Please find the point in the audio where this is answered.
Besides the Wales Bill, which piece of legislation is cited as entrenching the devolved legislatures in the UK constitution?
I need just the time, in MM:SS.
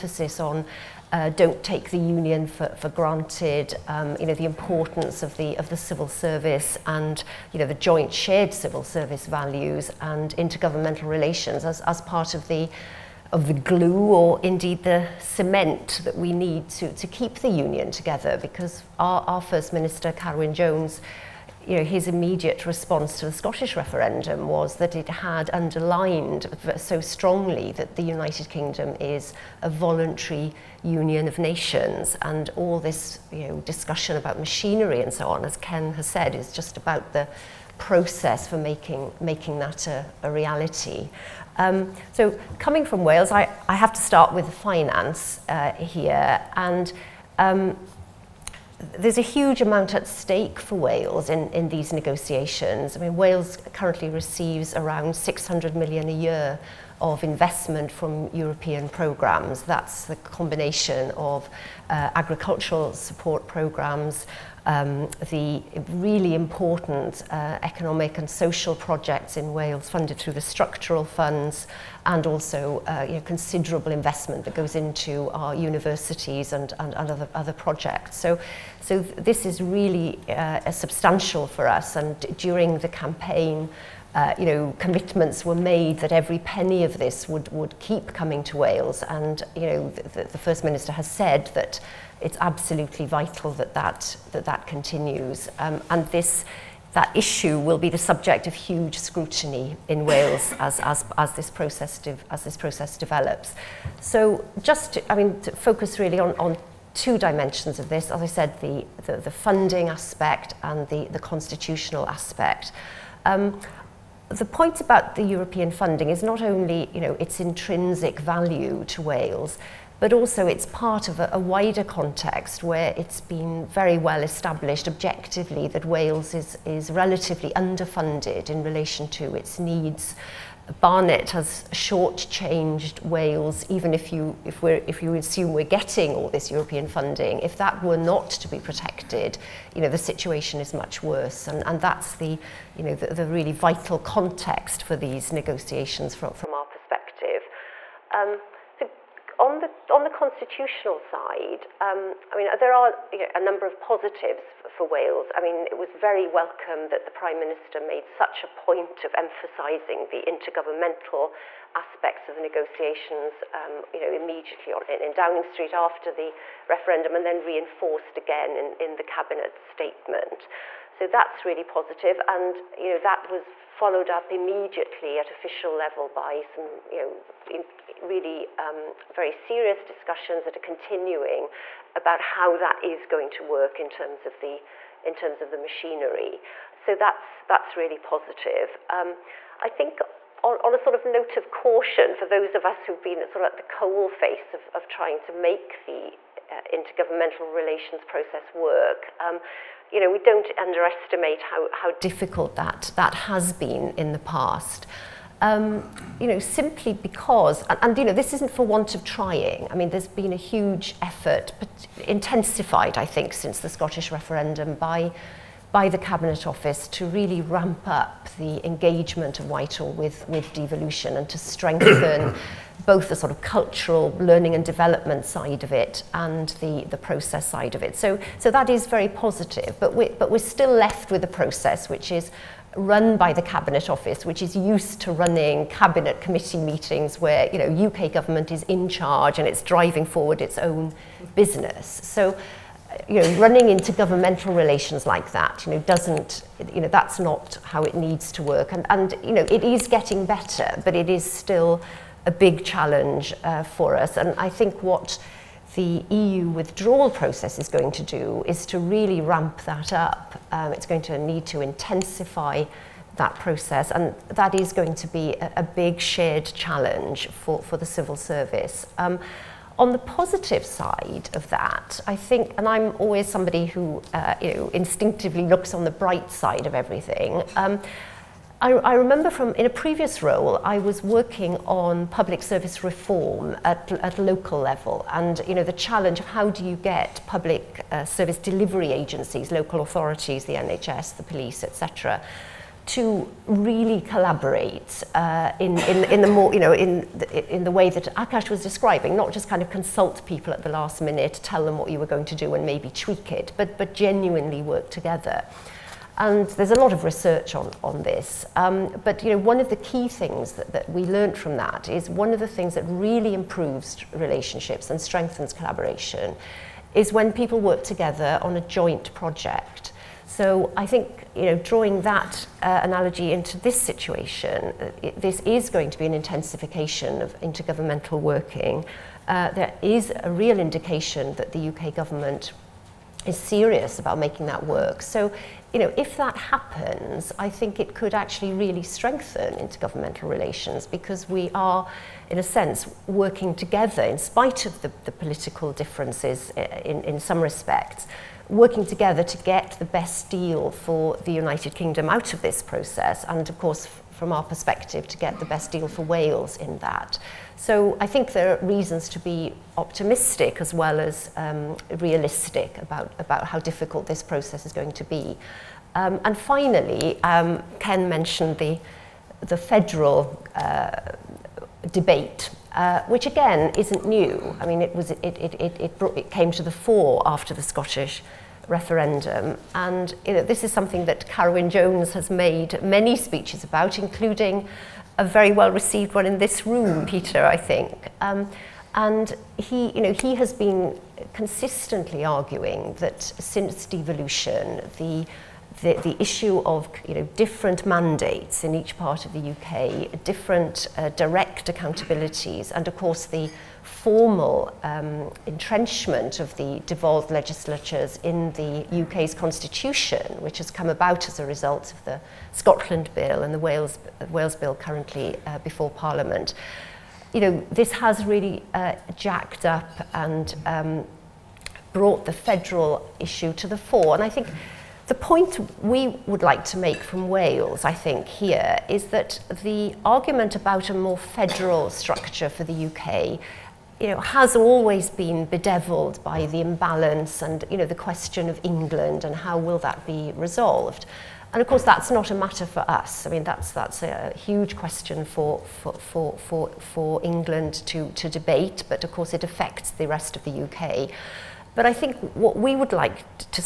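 06:52.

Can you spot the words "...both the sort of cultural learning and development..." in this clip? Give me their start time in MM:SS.
03:42.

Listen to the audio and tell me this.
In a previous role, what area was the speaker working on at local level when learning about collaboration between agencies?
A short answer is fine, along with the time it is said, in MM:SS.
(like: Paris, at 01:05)
public service reform, at 04:42.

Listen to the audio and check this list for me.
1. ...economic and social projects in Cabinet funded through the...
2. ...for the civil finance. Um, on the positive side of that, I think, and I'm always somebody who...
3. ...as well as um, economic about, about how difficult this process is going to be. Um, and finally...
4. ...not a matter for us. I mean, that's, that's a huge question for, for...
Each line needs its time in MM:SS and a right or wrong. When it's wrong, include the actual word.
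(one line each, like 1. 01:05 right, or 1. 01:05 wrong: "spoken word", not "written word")
1. 01:07 wrong: "Wales", not "Cabinet"
2. 04:27 wrong: "service", not "finance"
3. 06:00 wrong: "realistic", not "economic"
4. 07:22 right.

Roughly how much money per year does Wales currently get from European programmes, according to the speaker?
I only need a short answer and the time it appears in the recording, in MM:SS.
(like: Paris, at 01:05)
600 million, at 00:55.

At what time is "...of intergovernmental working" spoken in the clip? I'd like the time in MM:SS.
05:27.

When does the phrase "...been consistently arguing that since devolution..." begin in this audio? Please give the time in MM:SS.
06:30.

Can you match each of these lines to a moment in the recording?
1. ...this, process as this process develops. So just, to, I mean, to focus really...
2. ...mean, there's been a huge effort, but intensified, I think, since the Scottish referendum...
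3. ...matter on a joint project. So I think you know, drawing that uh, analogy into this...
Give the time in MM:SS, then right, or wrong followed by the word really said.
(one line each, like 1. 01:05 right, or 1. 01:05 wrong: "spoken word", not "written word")
1. 01:41 right
2. 03:29 right
3. 05:17 wrong: "together", not "matter".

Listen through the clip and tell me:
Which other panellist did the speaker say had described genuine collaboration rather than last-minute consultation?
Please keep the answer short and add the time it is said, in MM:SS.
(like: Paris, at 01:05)
Akash, at 04:58.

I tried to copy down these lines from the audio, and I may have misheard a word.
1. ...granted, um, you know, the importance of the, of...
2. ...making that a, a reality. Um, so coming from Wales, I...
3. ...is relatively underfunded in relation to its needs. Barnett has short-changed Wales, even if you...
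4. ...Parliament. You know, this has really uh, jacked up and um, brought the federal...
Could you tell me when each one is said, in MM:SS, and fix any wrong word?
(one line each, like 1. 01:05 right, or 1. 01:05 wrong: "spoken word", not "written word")
1. 00:02 right
2. 00:39 right
3. 02:06 right
4. 06:55 right.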